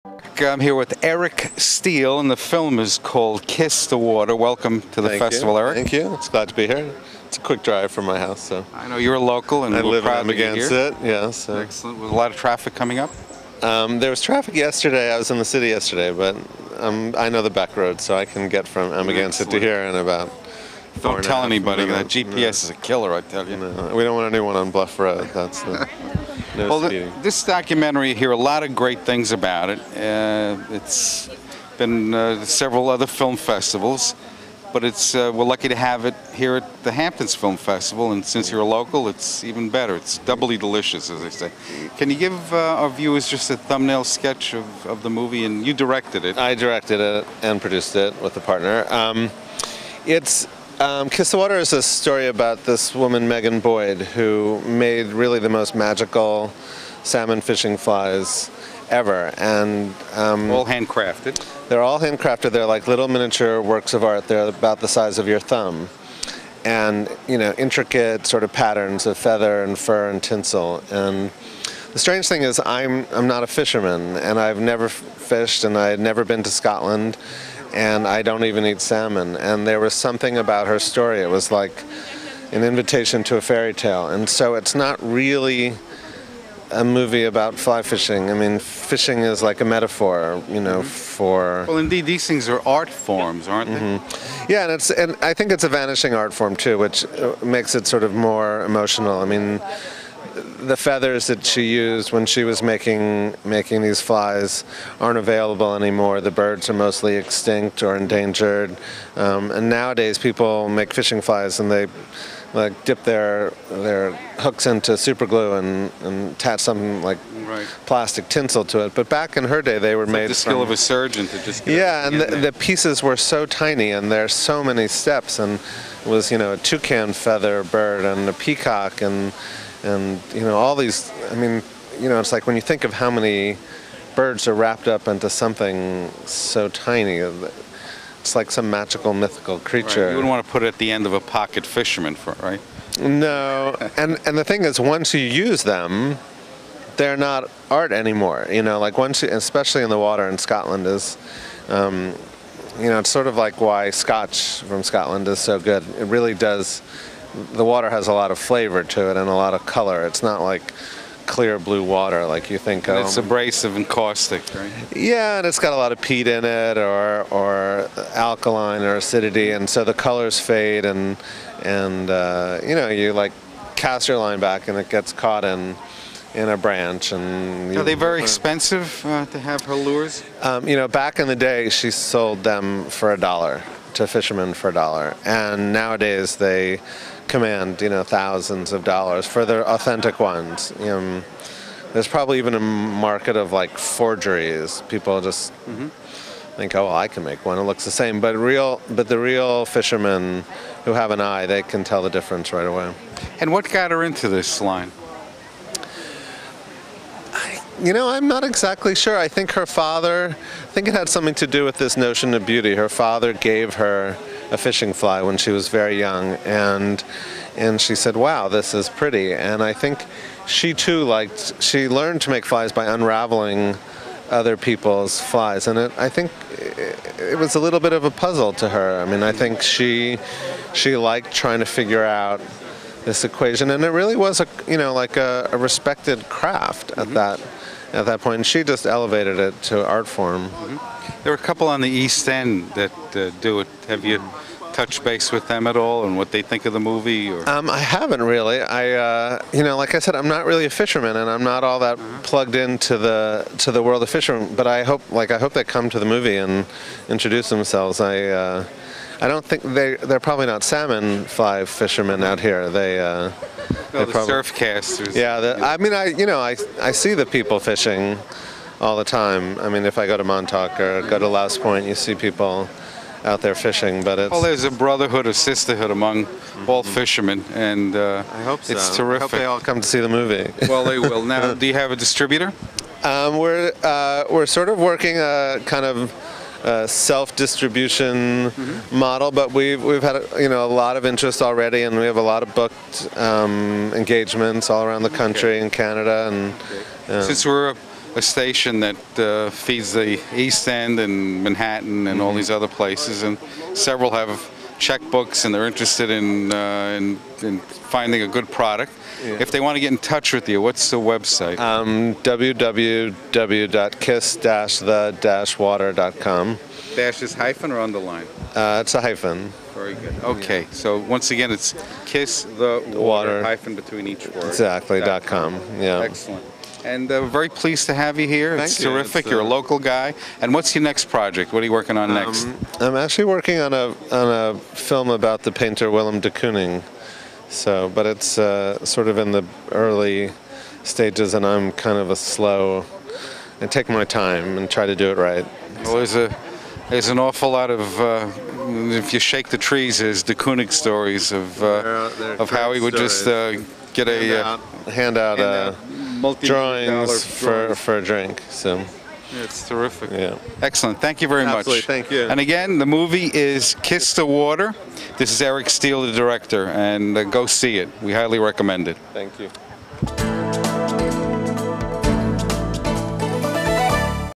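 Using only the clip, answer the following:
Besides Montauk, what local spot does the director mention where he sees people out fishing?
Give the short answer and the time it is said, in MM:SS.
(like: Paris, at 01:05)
Louse Point, at 04:31.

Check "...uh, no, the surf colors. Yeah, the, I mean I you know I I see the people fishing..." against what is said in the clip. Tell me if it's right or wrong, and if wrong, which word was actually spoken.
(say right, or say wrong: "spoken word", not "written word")
wrong: "casters", not "colors".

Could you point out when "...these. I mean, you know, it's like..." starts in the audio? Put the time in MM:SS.
02:10.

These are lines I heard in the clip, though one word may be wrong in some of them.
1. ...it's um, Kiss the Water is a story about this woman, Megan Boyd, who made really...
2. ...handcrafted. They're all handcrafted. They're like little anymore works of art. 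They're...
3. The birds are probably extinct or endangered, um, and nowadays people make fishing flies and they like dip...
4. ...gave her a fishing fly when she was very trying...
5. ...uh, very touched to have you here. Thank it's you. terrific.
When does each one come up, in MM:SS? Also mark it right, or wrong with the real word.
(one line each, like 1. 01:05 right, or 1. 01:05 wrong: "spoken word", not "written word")
1. 00:50 right
2. 01:00 wrong: "miniature", not "anymore"
3. 01:46 wrong: "mostly", not "probably"
4. 03:33 wrong: "young", not "trying"
5. 05:27 wrong: "pleased", not "touched".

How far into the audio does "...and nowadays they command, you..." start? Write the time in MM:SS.
03:05.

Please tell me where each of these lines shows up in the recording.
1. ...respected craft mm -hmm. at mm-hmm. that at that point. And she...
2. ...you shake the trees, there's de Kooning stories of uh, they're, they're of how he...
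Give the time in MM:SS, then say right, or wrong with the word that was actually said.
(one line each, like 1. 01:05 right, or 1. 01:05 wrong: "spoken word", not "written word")
1. 03:55 right
2. 05:49 right.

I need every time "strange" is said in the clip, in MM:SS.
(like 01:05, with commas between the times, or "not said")
01:11.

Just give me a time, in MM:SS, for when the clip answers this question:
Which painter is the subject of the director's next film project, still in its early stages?
05:35.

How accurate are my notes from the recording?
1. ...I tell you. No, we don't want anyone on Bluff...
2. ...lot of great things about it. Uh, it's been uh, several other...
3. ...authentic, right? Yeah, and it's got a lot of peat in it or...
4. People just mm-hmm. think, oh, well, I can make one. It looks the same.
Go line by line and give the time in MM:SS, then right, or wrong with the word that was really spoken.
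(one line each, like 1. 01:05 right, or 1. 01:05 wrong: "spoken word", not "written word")
1. 00:23 right
2. 00:28 right
3. 02:43 wrong: "caustic", not "authentic"
4. 03:14 right.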